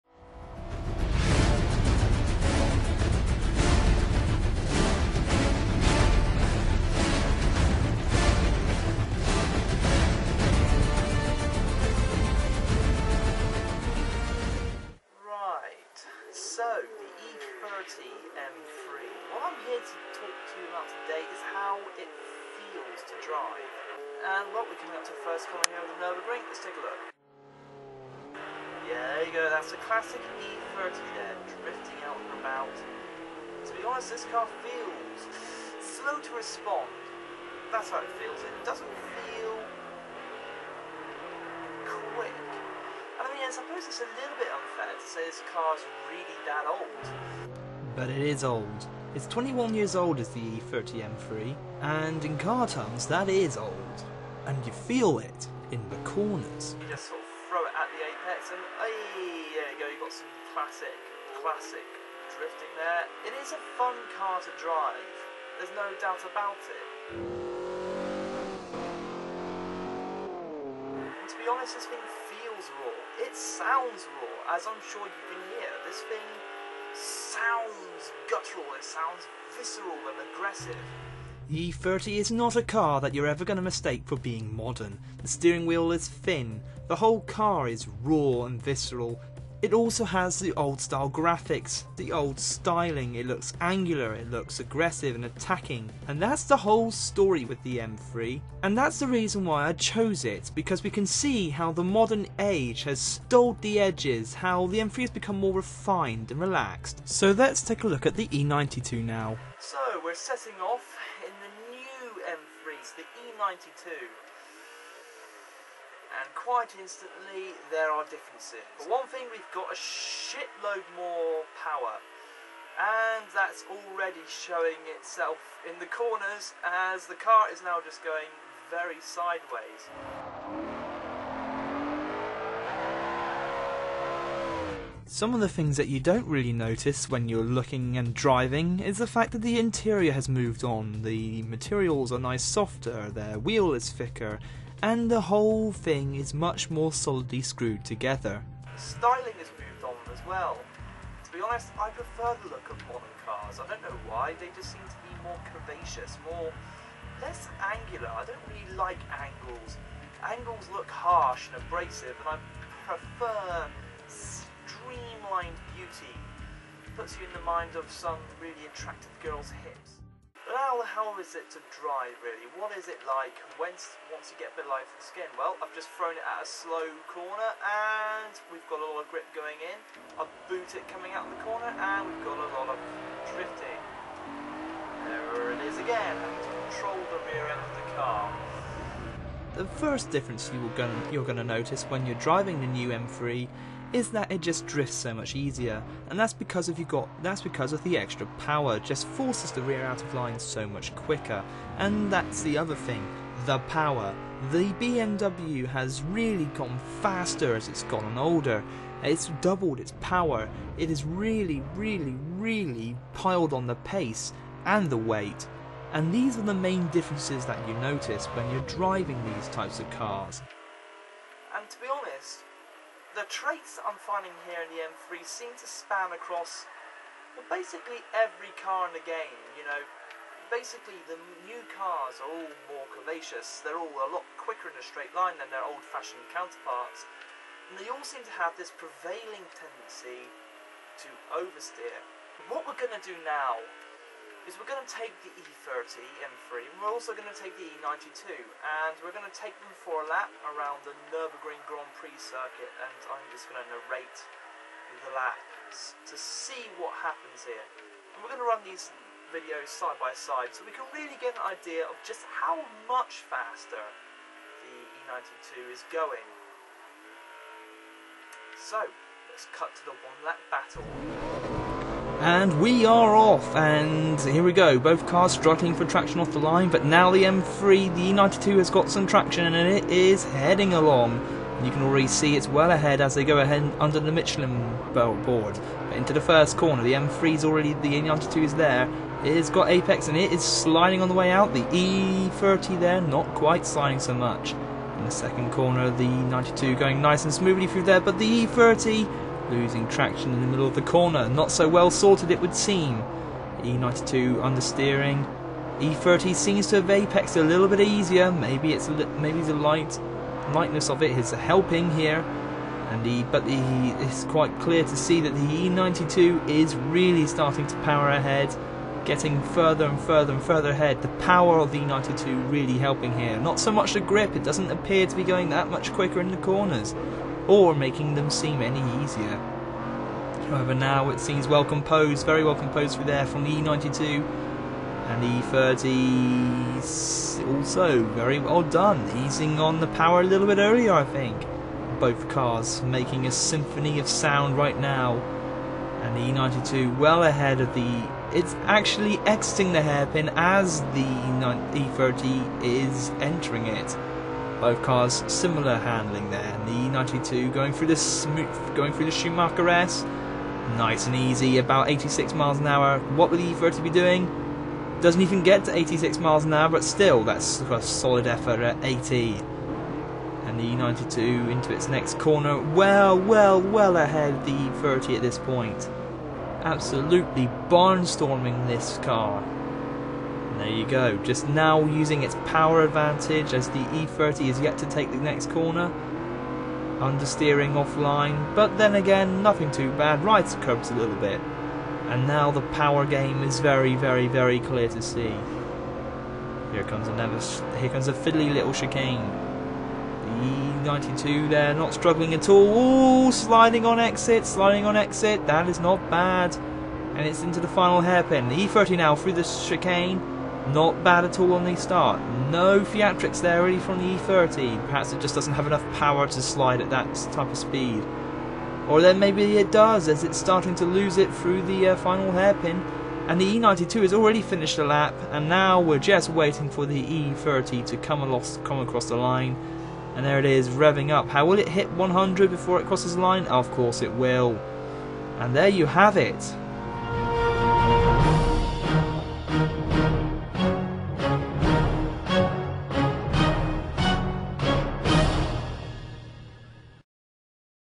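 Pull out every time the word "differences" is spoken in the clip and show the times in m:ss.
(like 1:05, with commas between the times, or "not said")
1:58, 3:10, 3:36.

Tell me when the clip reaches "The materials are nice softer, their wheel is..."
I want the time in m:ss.
2:21.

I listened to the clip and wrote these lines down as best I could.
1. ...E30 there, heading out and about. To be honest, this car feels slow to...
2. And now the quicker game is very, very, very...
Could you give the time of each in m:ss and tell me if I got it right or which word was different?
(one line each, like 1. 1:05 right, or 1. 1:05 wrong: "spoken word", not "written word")
1. 0:30 wrong: "drifting", not "heading"
2. 6:32 wrong: "power", not "quicker".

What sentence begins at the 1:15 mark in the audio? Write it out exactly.
This thing sounds guttural, it sounds visceral and aggressive.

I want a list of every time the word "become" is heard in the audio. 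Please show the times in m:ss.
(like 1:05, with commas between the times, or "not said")
1:45.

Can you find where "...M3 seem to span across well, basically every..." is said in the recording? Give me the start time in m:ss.
3:44.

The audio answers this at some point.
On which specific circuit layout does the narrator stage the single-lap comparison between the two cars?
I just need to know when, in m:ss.
4:11.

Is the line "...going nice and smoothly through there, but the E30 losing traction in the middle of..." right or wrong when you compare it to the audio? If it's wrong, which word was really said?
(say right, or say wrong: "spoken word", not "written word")
right.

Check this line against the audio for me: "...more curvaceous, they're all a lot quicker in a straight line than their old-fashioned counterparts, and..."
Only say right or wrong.
right.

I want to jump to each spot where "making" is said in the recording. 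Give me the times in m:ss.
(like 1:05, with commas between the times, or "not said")
5:27, 5:42.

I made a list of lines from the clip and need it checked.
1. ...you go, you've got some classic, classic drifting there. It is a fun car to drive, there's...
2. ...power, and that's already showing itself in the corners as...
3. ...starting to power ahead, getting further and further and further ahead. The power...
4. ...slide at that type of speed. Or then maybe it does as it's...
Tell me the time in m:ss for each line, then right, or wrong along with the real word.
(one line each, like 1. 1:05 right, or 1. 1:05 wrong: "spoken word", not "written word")
1. 0:59 right
2. 2:01 right
3. 5:17 right
4. 6:56 right.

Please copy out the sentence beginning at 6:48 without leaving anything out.
The E30 now through the chicane not bad at all on the start.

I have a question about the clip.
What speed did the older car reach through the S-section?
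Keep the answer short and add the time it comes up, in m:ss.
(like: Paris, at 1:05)
80, at 6:08.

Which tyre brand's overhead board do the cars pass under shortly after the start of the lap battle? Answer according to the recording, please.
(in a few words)
Michelin.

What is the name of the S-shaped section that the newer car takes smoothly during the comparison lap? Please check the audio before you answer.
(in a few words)
Schumacher S.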